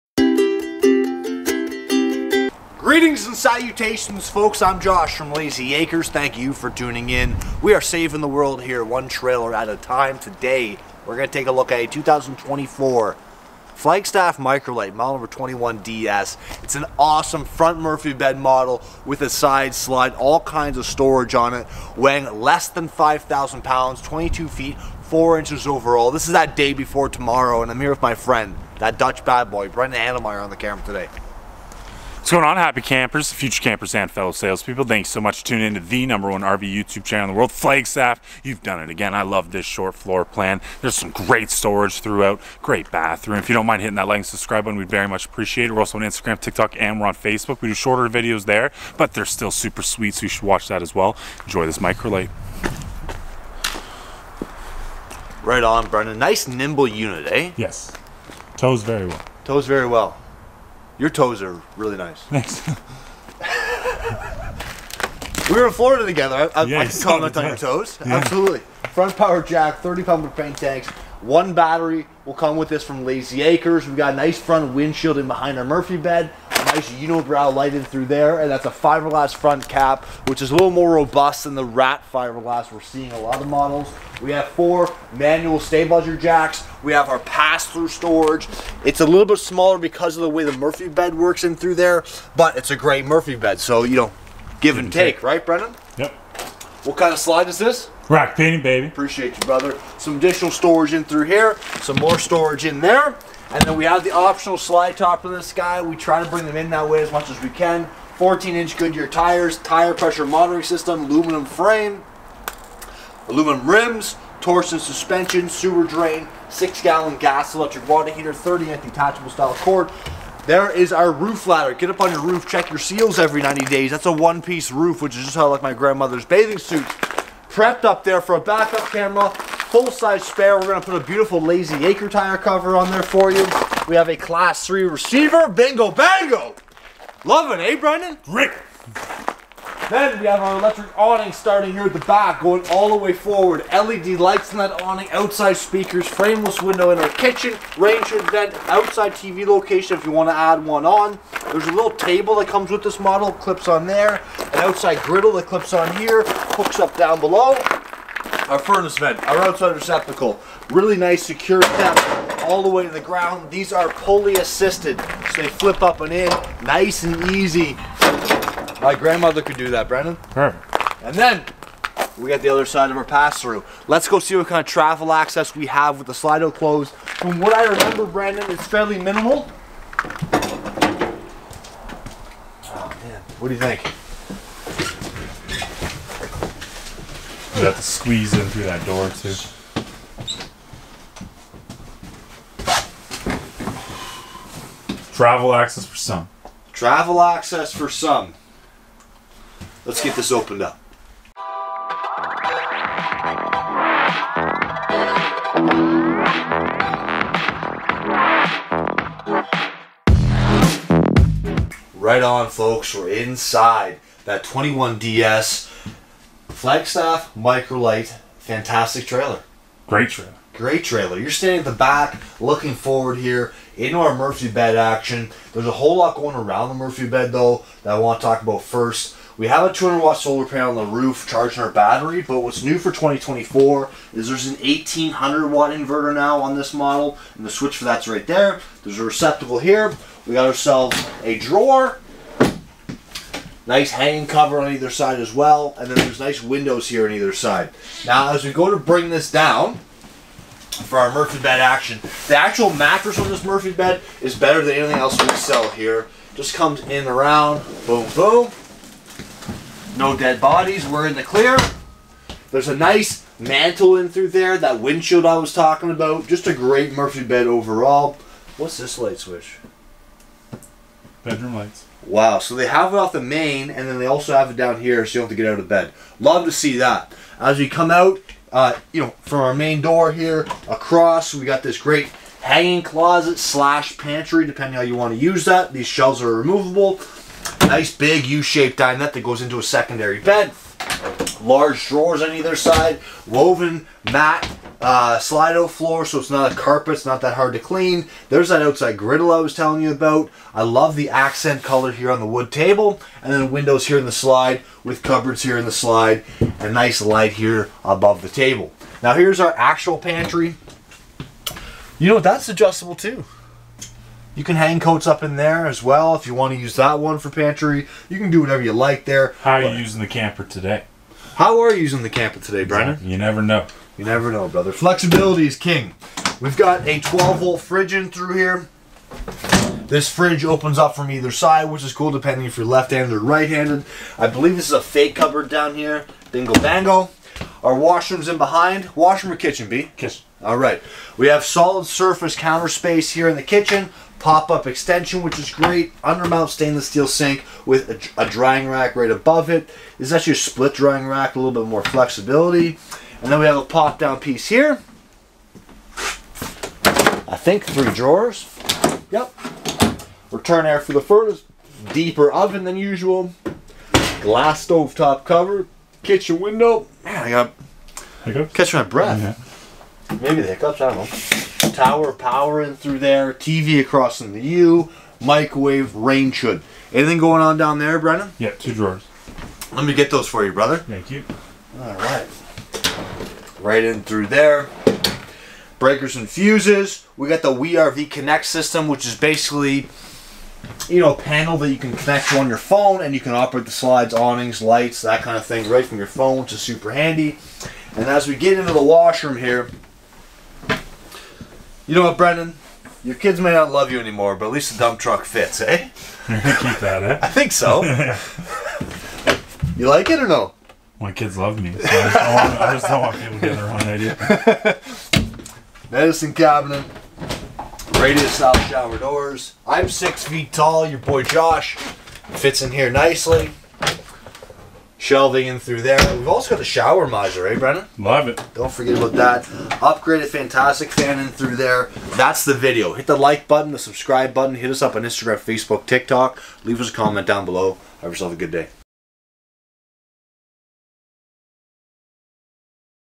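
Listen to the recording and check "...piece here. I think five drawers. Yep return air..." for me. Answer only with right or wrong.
wrong.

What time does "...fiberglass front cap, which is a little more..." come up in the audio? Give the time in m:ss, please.
1:18.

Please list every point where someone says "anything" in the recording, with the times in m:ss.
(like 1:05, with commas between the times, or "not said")
4:14, 6:16.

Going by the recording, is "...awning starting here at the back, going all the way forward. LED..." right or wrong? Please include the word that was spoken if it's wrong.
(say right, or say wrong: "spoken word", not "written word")
right.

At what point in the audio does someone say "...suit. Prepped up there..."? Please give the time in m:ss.
2:06.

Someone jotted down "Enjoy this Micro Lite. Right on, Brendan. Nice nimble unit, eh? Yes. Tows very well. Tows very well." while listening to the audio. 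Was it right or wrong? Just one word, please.
right.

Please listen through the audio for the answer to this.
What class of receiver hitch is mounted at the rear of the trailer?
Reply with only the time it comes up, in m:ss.
2:14.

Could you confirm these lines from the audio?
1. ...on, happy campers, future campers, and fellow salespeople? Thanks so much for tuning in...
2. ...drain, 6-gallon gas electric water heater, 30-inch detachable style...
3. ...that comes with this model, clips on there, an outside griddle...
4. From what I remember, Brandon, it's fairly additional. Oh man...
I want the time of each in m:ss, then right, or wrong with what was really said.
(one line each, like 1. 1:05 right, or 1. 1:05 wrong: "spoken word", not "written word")
1. 0:32 right
2. 1:55 right
3. 2:32 right
4. 2:56 wrong: "minimal", not "additional".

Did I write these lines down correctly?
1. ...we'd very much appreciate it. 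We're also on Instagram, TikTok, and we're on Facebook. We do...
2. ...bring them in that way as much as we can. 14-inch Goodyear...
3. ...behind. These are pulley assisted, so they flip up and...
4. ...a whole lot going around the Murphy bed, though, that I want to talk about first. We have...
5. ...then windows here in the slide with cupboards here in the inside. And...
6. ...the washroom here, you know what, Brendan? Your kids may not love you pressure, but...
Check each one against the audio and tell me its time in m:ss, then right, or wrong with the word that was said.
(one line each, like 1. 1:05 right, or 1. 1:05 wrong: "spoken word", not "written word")
1. 0:44 right
2. 1:46 right
3. 2:43 wrong: "ground", not "behind"
4. 3:45 right
5. 5:03 wrong: "slide", not "inside"
6. 6:38 wrong: "anymore", not "pressure".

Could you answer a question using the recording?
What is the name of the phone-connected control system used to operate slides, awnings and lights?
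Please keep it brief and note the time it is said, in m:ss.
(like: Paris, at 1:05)
WeRV Connect, at 6:27.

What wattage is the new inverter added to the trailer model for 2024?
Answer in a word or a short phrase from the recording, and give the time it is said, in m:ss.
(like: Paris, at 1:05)
1800 watt, at 3:54.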